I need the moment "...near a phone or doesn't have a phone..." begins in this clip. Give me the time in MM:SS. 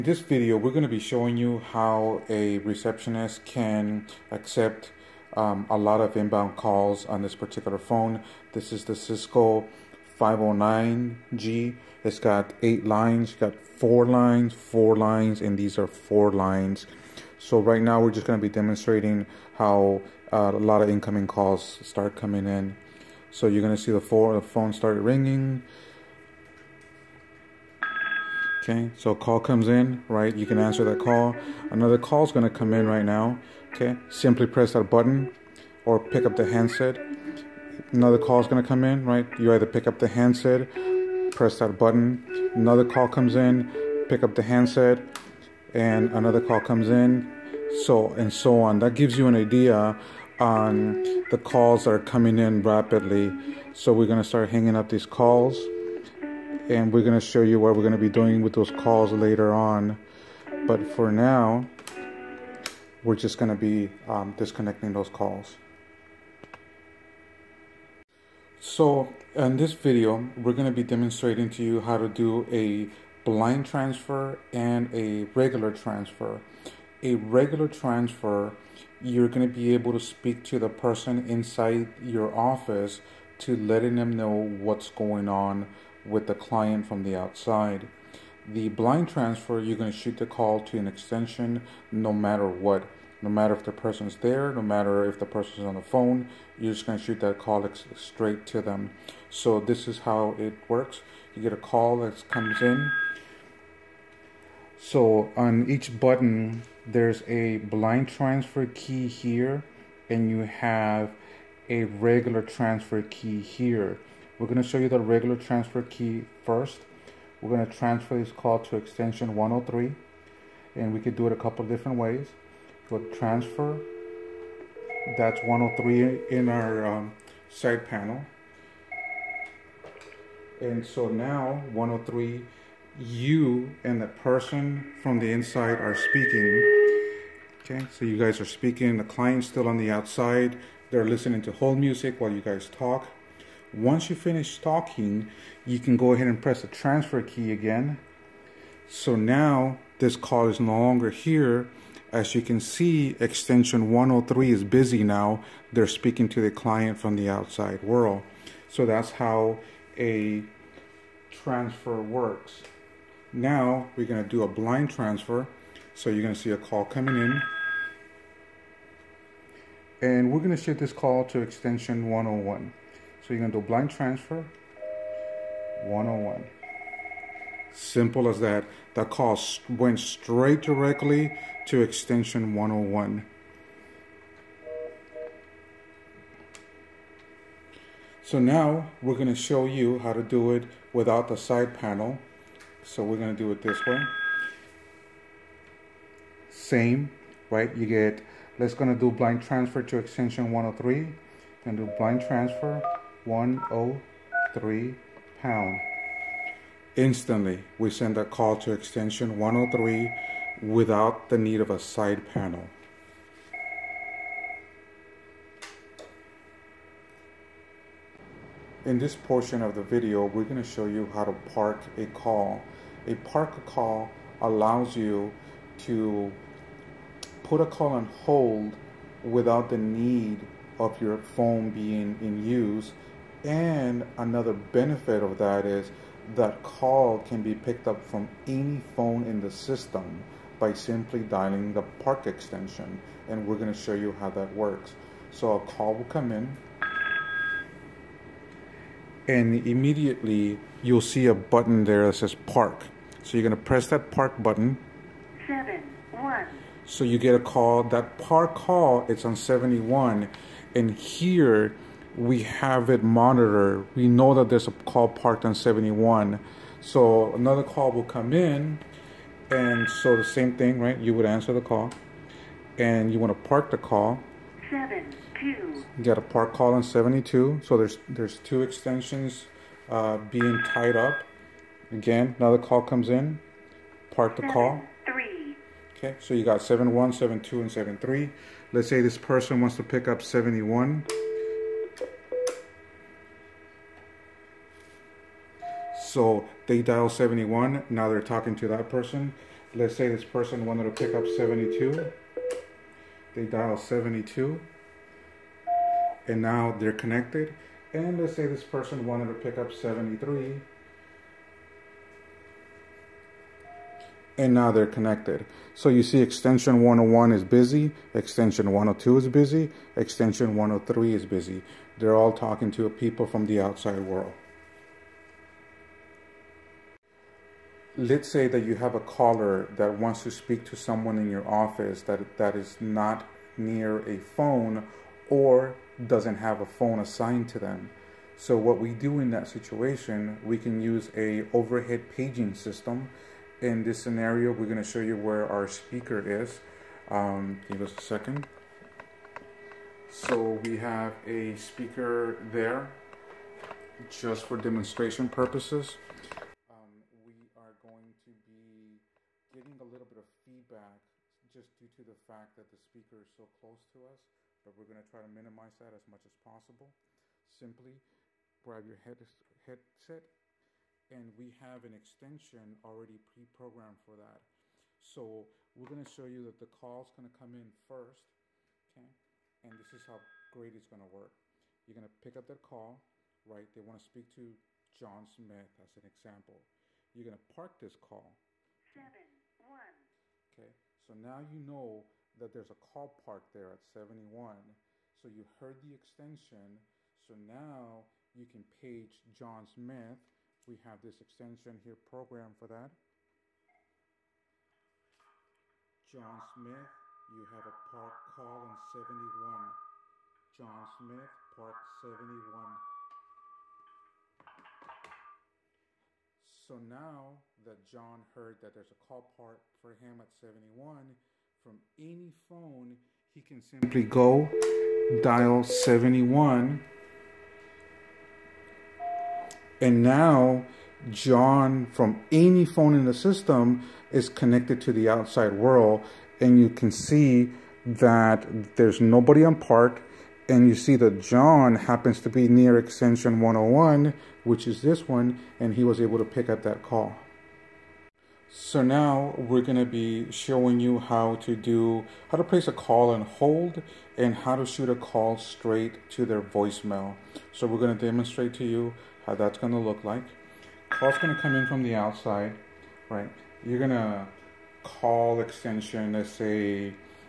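05:33.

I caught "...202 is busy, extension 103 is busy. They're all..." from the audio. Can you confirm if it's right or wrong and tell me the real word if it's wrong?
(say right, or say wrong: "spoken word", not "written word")
wrong: "102", not "202".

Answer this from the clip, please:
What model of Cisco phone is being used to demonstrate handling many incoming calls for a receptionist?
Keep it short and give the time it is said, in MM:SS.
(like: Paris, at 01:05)
509G, at 00:10.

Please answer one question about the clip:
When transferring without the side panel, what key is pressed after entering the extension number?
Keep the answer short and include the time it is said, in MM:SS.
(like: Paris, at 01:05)
pound, at 03:25.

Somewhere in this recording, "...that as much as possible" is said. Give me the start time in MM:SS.
06:05.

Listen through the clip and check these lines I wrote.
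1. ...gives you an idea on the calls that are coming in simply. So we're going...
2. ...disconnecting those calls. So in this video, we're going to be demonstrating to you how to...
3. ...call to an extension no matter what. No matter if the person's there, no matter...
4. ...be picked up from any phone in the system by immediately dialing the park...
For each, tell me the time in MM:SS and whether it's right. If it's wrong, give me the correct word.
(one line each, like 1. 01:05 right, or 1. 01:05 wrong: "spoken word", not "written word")
1. 00:48 wrong: "rapidly", not "simply"
2. 01:04 right
3. 01:30 right
4. 03:57 wrong: "simply", not "immediately".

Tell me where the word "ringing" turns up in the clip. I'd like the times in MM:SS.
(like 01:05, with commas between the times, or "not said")
00:24.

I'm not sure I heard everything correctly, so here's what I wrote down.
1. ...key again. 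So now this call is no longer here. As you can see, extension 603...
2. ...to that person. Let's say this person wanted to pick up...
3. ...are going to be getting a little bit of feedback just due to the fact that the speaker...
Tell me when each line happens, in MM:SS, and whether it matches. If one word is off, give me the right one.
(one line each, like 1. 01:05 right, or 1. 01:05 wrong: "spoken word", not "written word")
1. 02:27 wrong: "103", not "603"
2. 04:58 right
3. 05:57 right.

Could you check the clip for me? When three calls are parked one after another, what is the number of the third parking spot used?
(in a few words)
73.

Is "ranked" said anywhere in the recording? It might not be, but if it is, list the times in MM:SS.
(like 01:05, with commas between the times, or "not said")
not said.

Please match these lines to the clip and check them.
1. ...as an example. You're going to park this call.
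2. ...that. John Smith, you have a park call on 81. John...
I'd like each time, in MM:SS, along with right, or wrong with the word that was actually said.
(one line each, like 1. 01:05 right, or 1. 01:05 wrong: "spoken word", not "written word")
1. 06:25 right
2. 06:42 wrong: "71", not "81".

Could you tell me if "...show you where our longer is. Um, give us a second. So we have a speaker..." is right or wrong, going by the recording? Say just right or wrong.
wrong.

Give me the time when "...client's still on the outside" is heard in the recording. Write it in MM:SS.
02:19.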